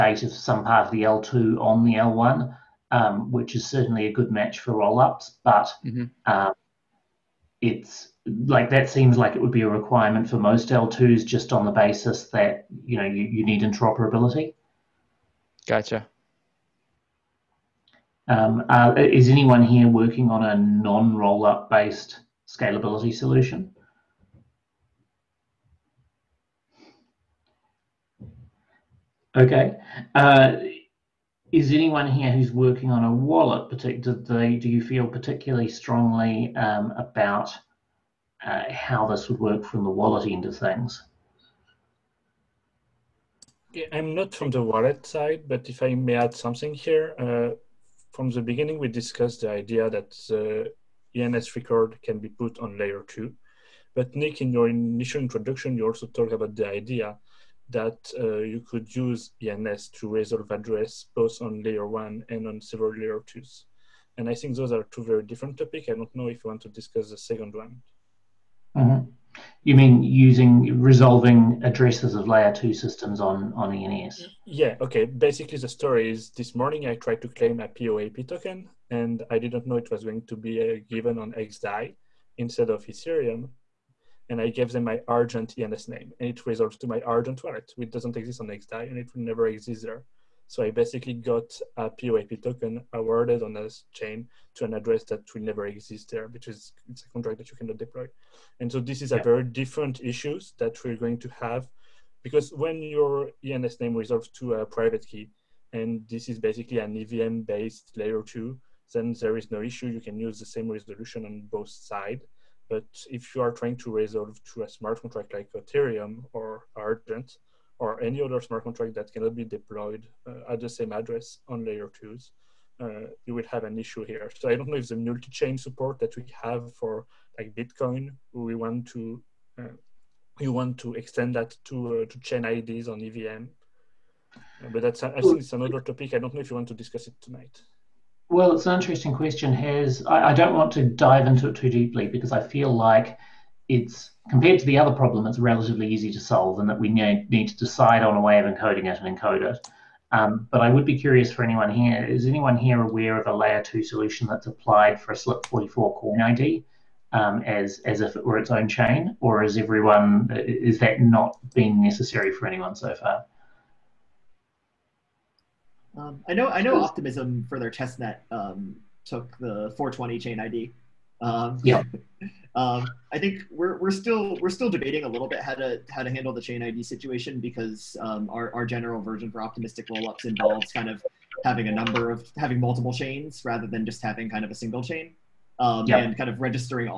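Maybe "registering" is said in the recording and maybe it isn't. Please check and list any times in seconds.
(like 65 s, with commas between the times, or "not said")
186 s.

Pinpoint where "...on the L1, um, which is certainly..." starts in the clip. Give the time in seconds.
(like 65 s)
1 s.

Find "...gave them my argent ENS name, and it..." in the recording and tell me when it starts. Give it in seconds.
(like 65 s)
84 s.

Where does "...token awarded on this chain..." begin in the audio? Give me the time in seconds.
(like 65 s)
92 s.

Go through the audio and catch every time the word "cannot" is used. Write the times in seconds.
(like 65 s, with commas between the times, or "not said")
97 s, 119 s.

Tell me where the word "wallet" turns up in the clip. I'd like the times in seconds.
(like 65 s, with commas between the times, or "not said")
33 s, 39 s, 44 s, 87 s.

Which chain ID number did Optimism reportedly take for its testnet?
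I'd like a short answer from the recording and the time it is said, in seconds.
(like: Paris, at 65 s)
420, at 169 s.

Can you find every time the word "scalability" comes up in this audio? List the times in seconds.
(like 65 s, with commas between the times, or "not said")
22 s.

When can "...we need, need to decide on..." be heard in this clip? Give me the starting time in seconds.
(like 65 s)
146 s.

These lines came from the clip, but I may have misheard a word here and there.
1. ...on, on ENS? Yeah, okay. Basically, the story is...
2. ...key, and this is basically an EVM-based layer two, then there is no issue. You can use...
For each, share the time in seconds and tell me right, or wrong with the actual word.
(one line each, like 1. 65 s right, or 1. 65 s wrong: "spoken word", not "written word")
1. 73 s right
2. 105 s right.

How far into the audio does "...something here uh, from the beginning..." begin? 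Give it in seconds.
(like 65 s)
46 s.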